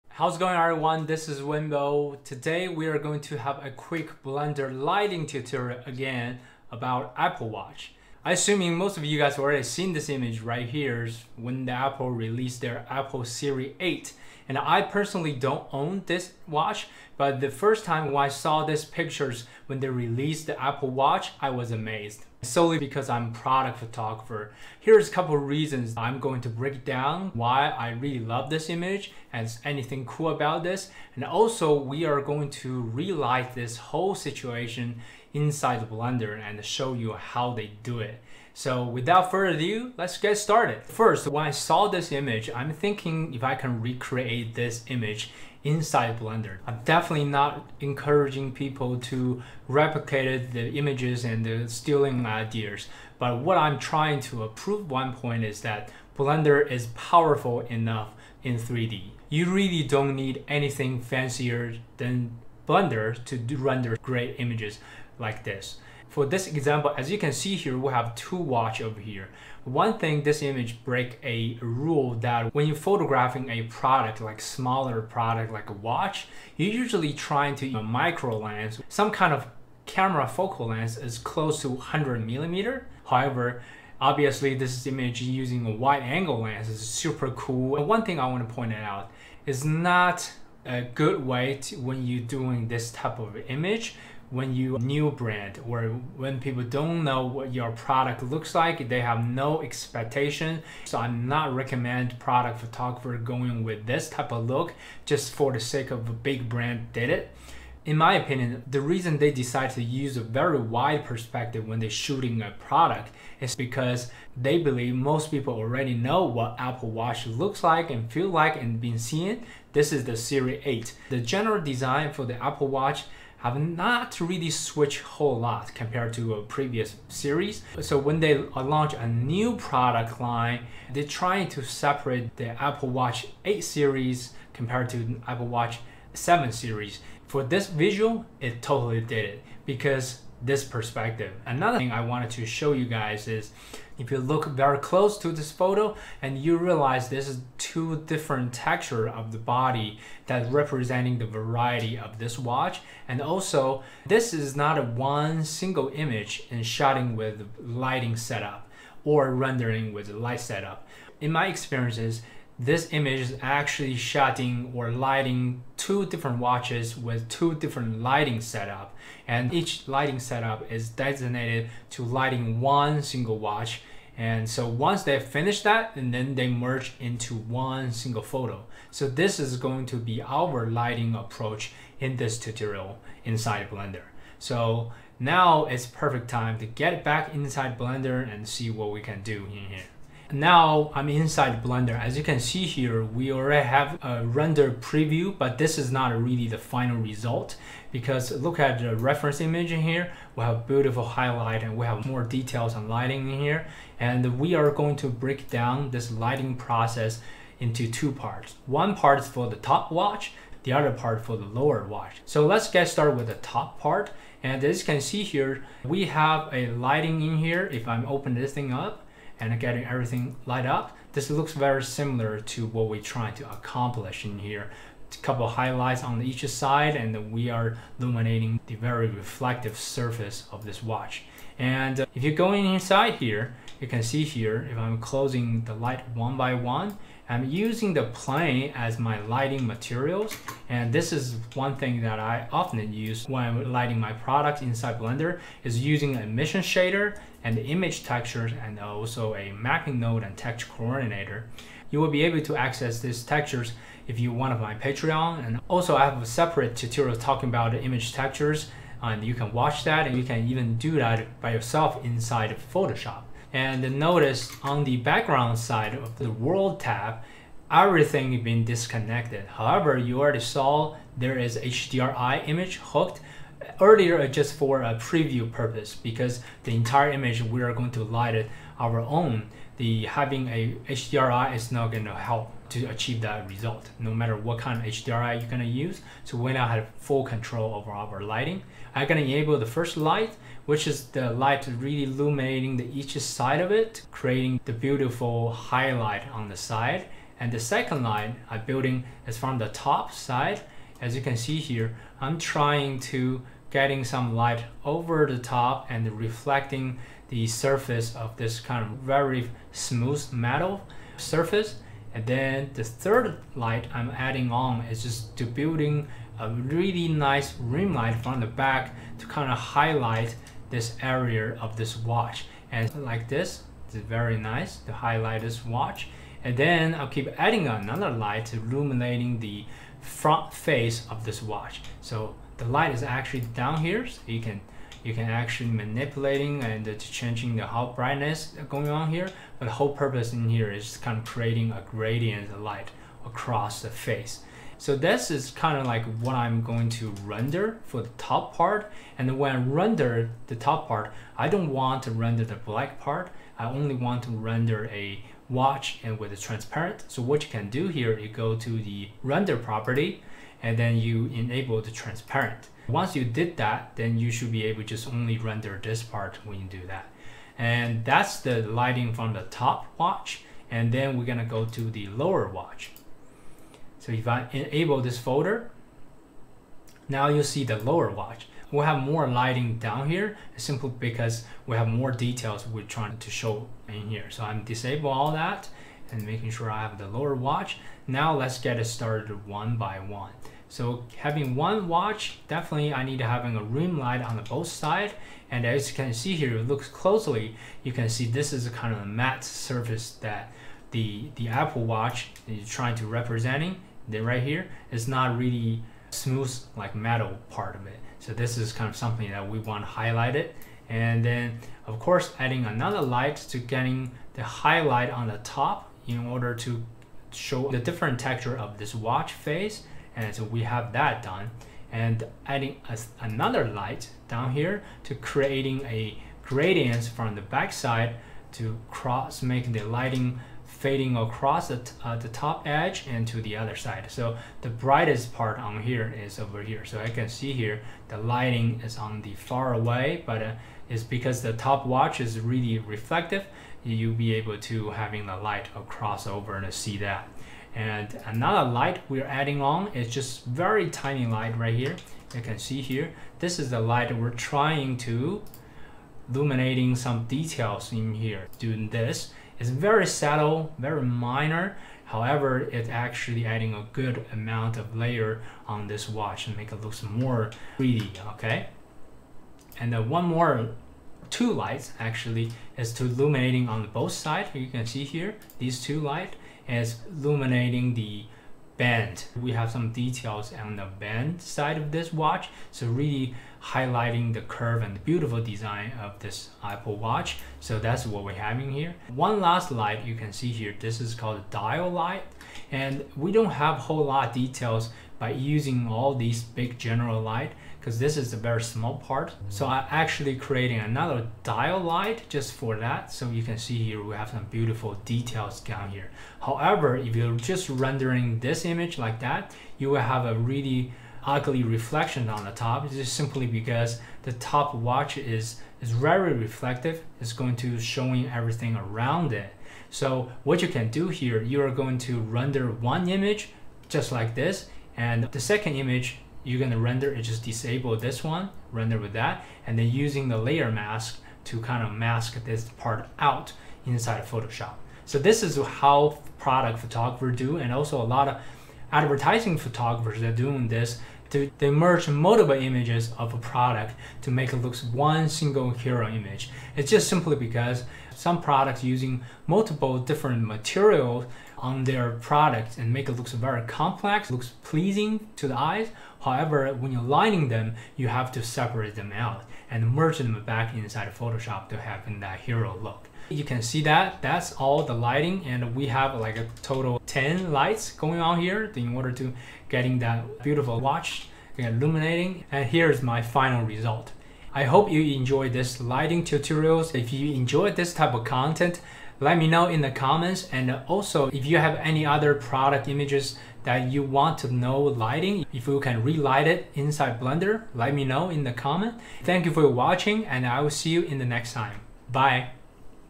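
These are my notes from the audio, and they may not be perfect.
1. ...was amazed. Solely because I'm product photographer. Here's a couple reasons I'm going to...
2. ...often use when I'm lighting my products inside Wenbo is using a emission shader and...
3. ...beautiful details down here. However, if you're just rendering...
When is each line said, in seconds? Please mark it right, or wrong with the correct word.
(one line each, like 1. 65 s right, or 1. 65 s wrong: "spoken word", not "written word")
1. 21 s right
2. 242 s wrong: "Blender", not "Wenbo"
3. 504 s right.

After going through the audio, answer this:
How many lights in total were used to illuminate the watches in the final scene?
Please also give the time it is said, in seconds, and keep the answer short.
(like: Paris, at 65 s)
10, at 567 s.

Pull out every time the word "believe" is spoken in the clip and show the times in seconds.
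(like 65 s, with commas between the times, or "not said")
114 s.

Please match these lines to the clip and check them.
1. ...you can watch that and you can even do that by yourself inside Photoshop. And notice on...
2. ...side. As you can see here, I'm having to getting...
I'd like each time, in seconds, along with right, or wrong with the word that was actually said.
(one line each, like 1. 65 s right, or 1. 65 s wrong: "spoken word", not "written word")
1. 259 s right
2. 300 s wrong: "trying", not "having".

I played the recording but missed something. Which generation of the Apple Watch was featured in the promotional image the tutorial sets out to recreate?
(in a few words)
Series 8.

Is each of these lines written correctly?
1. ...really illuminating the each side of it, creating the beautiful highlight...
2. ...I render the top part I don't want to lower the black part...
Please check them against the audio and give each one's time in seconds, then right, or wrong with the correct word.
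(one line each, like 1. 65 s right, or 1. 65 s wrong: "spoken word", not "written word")
1. 291 s right
2. 349 s wrong: "render", not "lower".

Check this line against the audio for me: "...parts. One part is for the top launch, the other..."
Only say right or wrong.
wrong.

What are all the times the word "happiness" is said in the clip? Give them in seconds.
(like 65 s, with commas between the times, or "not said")
not said.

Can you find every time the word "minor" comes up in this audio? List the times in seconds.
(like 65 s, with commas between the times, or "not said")
461 s.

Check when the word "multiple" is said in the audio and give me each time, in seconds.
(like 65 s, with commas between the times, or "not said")
542 s, 549 s.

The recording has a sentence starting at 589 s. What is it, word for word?
Thank you for watching and I will see you in the next time.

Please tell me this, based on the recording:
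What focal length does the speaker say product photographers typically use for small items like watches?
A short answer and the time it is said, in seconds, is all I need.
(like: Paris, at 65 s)
100 millimeter, at 81 s.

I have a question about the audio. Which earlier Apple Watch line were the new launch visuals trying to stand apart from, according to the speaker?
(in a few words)
Apple Watch 7 series.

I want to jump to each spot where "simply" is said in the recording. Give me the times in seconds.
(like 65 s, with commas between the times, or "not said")
380 s, 513 s, 547 s.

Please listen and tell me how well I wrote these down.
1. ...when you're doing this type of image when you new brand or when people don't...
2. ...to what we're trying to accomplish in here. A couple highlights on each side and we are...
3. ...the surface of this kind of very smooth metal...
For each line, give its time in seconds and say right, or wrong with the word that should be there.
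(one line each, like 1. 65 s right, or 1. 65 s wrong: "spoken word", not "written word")
1. 91 s right
2. 222 s right
3. 307 s right.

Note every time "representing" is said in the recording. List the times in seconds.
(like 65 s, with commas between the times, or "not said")
150 s, 403 s.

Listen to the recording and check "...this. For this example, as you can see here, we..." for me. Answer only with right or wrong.
right.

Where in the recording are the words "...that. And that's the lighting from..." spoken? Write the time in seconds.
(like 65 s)
366 s.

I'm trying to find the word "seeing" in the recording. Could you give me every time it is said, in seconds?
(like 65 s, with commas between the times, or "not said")
118 s.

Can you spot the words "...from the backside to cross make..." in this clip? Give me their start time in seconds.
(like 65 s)
427 s.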